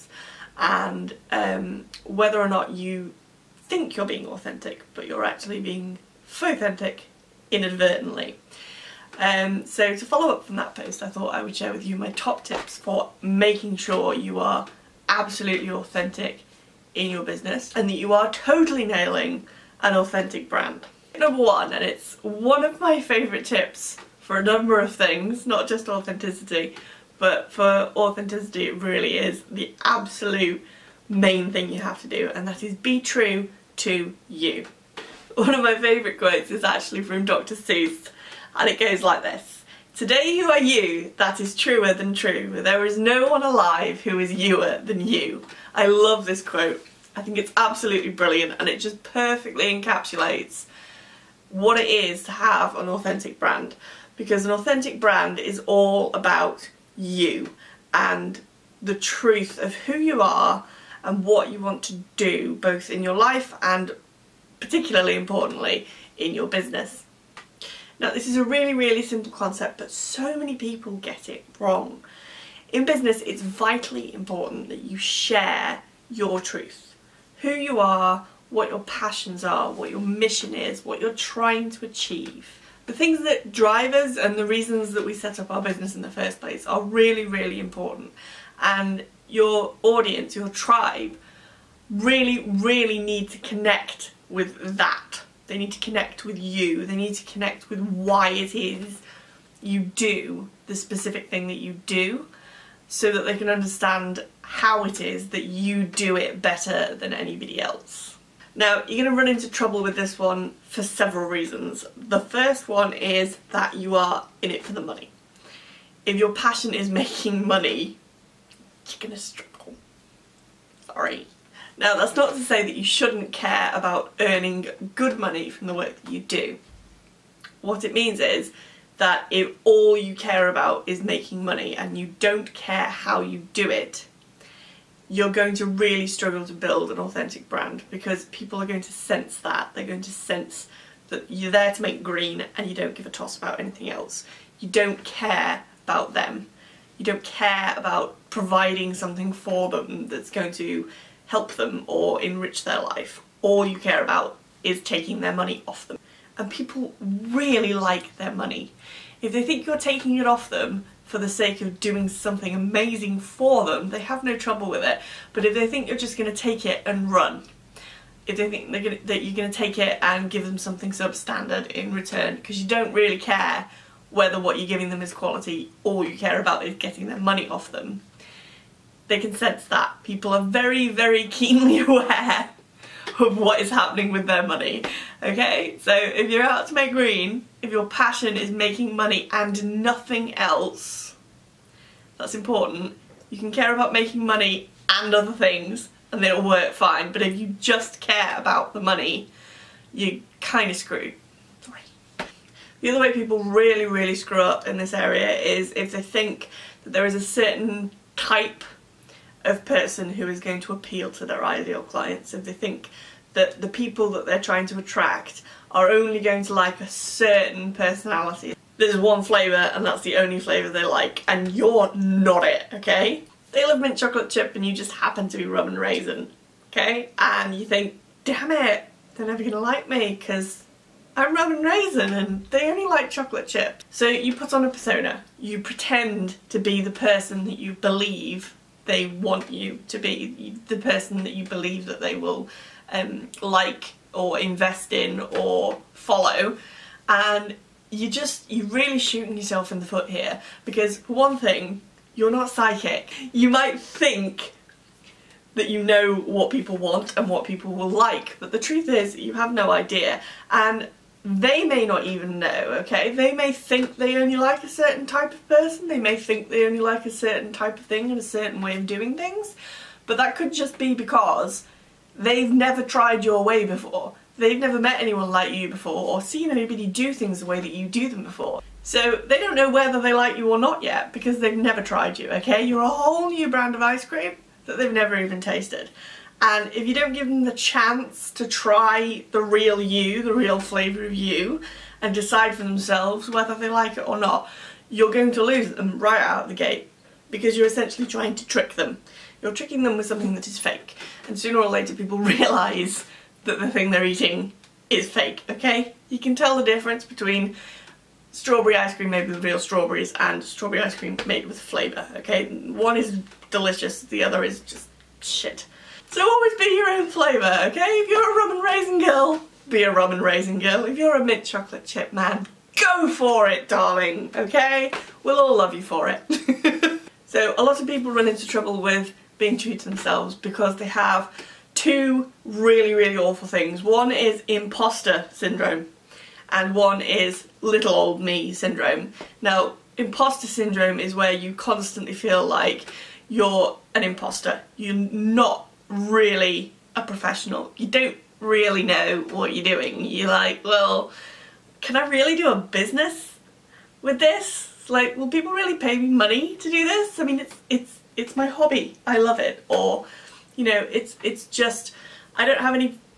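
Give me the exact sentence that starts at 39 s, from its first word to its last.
Today you are you, that is truer than true.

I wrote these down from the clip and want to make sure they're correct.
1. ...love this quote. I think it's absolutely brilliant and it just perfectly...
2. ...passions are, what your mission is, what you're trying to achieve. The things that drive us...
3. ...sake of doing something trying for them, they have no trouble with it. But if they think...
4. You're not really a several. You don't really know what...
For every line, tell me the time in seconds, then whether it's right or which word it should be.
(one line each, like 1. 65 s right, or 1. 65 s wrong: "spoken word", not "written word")
1. 45 s right
2. 78 s right
3. 161 s wrong: "amazing", not "trying"
4. 344 s wrong: "professional", not "several".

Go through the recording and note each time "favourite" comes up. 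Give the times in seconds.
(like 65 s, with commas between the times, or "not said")
23 s, 35 s.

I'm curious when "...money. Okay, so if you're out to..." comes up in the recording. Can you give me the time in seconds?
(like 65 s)
184 s.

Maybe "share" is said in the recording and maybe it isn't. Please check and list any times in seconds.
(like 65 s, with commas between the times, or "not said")
11 s, 74 s.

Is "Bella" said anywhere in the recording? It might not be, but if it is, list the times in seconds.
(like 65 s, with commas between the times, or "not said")
not said.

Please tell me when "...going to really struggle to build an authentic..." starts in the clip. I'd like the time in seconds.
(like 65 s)
135 s.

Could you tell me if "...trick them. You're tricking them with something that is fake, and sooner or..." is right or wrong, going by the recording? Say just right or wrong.
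right.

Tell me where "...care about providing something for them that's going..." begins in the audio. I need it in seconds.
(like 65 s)
147 s.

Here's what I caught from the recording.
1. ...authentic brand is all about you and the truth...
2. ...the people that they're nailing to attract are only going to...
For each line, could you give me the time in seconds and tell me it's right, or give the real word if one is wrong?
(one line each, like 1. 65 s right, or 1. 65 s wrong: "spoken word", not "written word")
1. 54 s right
2. 213 s wrong: "trying", not "nailing".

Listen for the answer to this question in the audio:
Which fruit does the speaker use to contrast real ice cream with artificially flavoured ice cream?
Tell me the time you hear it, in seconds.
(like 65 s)
309 s.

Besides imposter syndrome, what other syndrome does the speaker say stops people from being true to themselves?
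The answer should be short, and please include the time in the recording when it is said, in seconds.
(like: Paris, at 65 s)
little old me syndrome, at 337 s.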